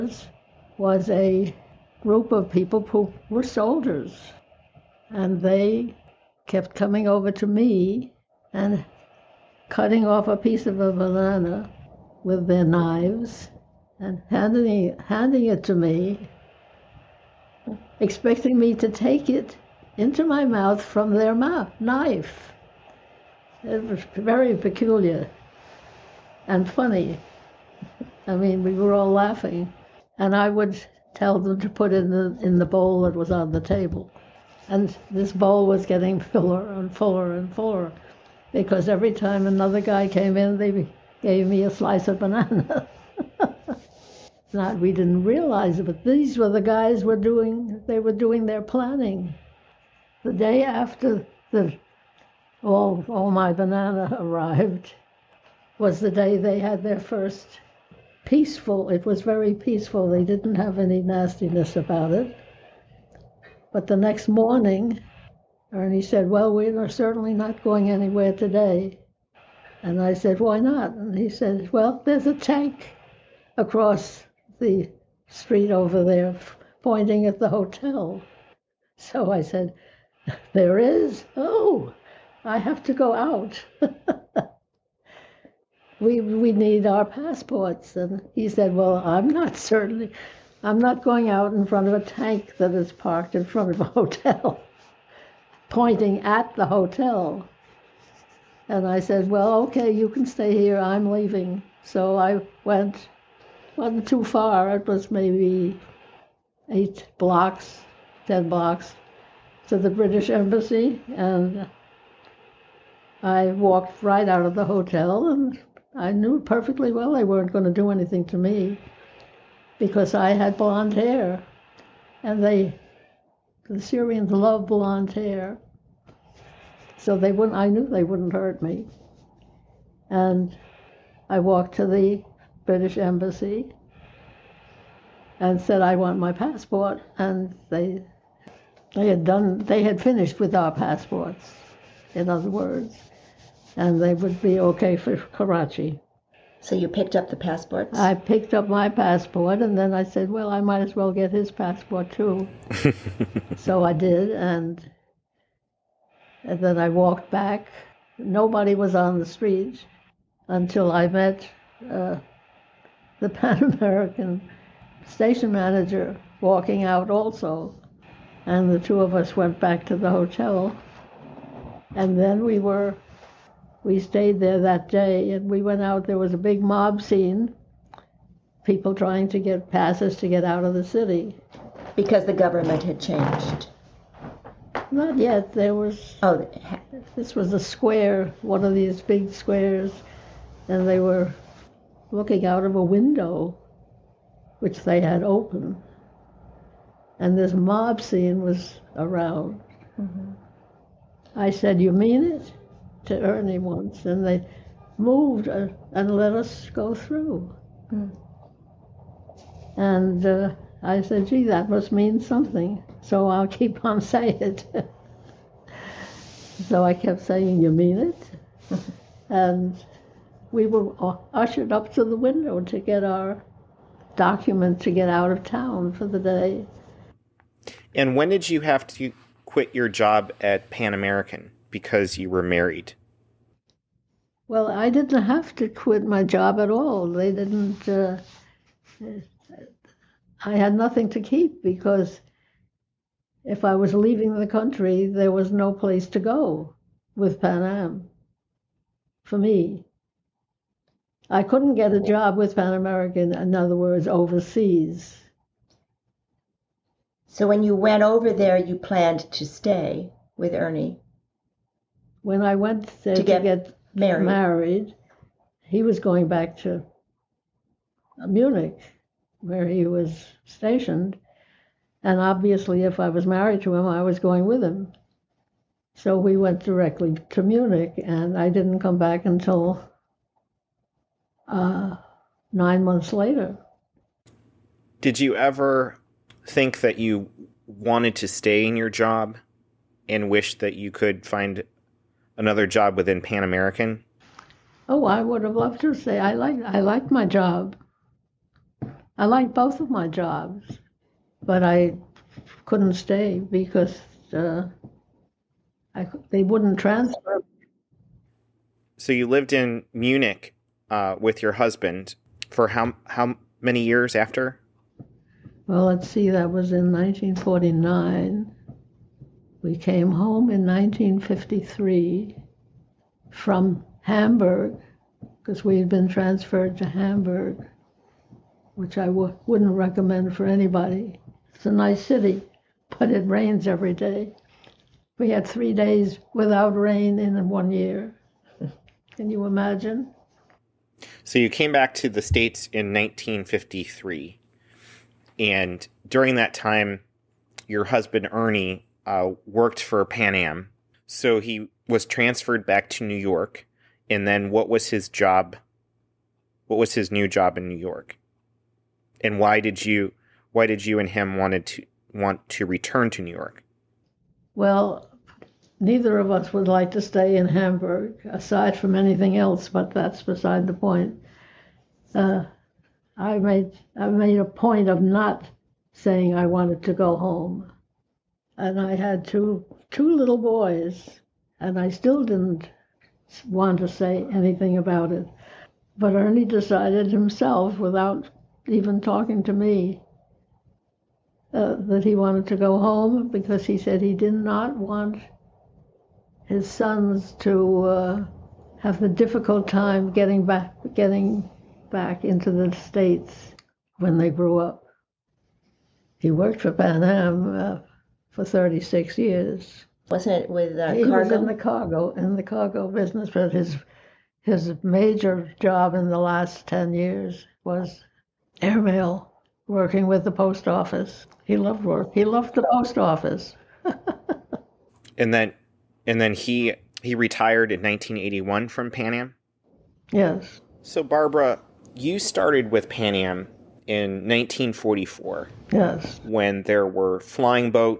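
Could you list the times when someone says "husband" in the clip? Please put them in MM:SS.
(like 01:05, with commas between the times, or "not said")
05:11, 05:47.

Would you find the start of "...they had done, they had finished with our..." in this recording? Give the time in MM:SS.
02:18.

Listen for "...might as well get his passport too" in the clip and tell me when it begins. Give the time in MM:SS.
02:30.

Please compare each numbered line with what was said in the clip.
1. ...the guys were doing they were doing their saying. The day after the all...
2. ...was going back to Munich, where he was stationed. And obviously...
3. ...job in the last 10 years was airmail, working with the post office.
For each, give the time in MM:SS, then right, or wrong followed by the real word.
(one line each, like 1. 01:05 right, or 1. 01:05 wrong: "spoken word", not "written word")
1. 00:46 wrong: "planning", not "saying"
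2. 04:25 right
3. 06:55 right.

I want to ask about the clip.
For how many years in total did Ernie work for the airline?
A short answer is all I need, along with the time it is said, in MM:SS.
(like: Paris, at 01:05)
36, at 06:48.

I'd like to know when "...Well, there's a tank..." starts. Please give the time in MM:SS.
01:11.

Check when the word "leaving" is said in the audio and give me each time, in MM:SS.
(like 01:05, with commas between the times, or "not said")
01:41, 04:03.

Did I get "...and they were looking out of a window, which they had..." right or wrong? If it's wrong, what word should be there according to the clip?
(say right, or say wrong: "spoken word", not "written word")
right.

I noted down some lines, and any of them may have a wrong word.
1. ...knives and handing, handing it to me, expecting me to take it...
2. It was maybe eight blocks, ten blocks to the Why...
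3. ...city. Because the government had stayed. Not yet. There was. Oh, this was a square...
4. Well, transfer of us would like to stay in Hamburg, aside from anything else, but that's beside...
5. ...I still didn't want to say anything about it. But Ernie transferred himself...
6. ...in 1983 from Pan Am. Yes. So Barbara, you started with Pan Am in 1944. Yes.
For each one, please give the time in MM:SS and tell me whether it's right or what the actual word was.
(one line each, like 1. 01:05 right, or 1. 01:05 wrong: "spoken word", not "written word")
1. 00:12 right
2. 01:44 wrong: "British", not "Why"
3. 03:00 wrong: "changed", not "stayed"
4. 06:04 wrong: "neither", not "transfer"
5. 06:21 wrong: "decided", not "transferred"
6. 07:07 wrong: "1981", not "1983".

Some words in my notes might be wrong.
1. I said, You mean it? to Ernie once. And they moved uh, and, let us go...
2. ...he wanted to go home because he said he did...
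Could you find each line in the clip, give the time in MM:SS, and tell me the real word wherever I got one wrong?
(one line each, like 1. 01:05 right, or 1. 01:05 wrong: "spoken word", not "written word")
1. 03:21 right
2. 06:32 right.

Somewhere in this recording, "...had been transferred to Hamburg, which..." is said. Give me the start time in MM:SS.
05:25.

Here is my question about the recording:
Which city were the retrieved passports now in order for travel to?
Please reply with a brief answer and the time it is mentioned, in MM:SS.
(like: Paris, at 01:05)
Karachi, at 02:25.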